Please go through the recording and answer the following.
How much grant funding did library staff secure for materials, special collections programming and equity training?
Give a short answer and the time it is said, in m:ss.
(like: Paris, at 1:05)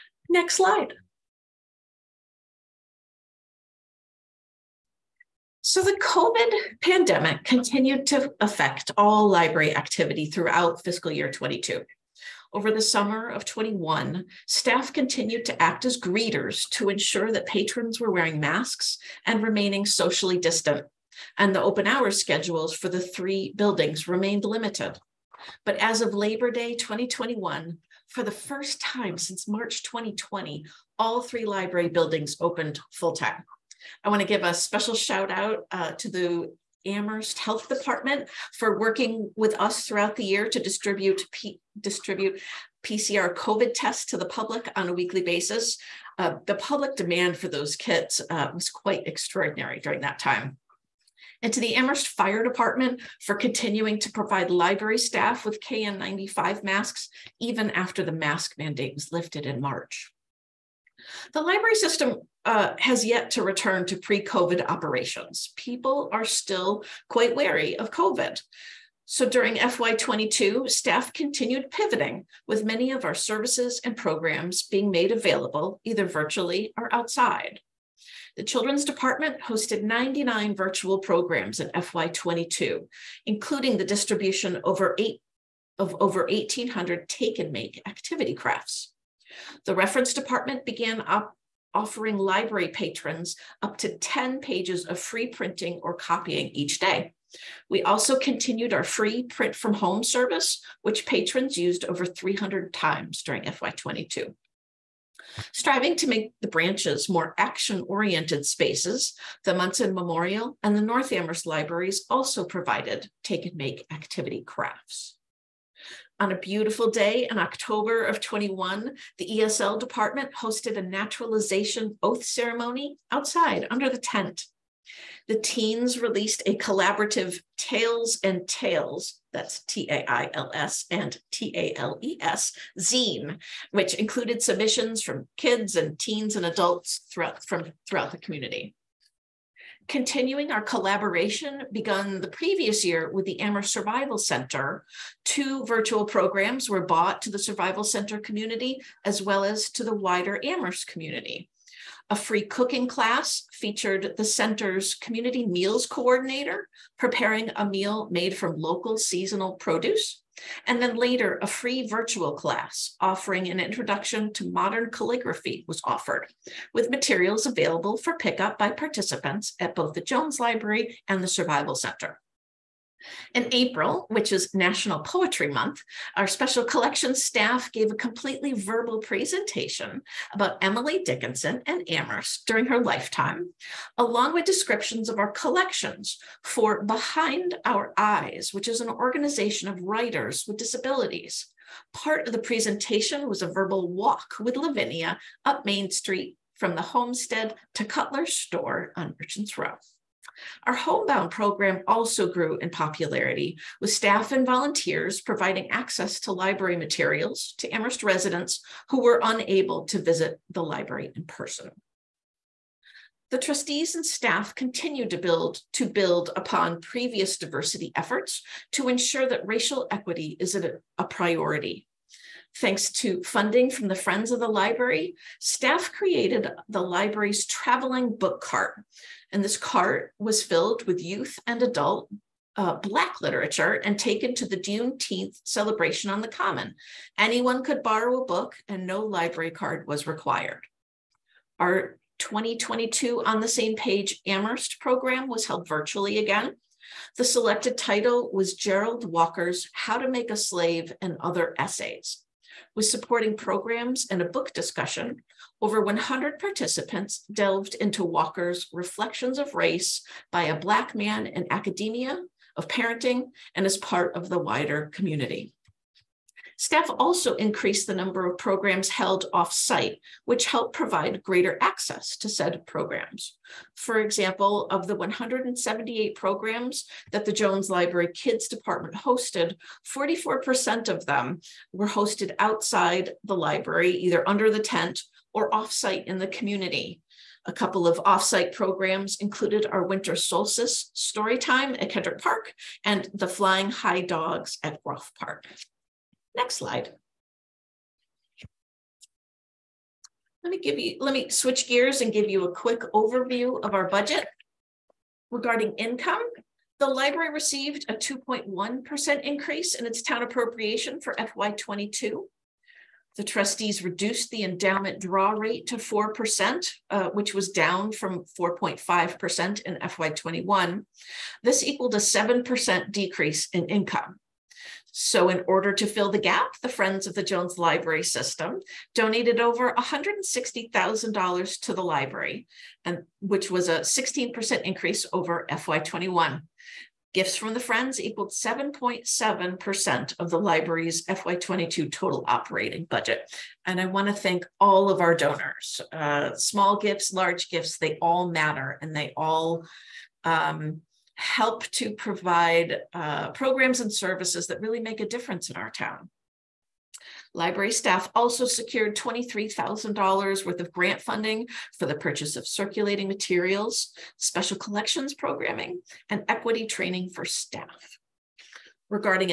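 $23,000, at 5:58.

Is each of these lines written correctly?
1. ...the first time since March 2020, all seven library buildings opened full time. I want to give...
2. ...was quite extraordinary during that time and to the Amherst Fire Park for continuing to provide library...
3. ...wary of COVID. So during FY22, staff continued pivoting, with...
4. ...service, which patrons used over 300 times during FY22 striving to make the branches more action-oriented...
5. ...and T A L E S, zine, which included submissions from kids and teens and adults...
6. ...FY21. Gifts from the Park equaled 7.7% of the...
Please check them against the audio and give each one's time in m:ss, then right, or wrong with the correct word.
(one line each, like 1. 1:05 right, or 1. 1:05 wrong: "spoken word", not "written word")
1. 0:28 wrong: "three", not "seven"
2. 0:48 wrong: "Department", not "Park"
3. 1:07 right
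4. 1:40 right
5. 2:10 right
6. 5:35 wrong: "Friends", not "Park".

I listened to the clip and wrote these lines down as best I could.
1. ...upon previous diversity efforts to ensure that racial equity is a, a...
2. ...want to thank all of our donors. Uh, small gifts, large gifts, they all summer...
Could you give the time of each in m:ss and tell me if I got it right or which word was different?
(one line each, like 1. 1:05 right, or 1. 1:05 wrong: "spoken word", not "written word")
1. 3:36 right
2. 5:43 wrong: "matter", not "summer".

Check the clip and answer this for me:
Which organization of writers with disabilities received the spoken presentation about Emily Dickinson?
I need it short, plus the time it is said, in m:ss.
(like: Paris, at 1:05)
Behind Our Eyes, at 3:06.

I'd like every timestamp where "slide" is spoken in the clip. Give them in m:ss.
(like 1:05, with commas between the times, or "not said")
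0:00, 4:56.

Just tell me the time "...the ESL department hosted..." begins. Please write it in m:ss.
1:59.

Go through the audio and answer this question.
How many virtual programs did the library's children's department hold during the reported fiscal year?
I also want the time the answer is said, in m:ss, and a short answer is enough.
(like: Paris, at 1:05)
99, at 1:19.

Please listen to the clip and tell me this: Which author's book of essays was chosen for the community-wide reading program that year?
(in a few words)
Jerald Walker.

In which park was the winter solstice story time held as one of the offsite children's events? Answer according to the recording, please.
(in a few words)
Kendrick Park.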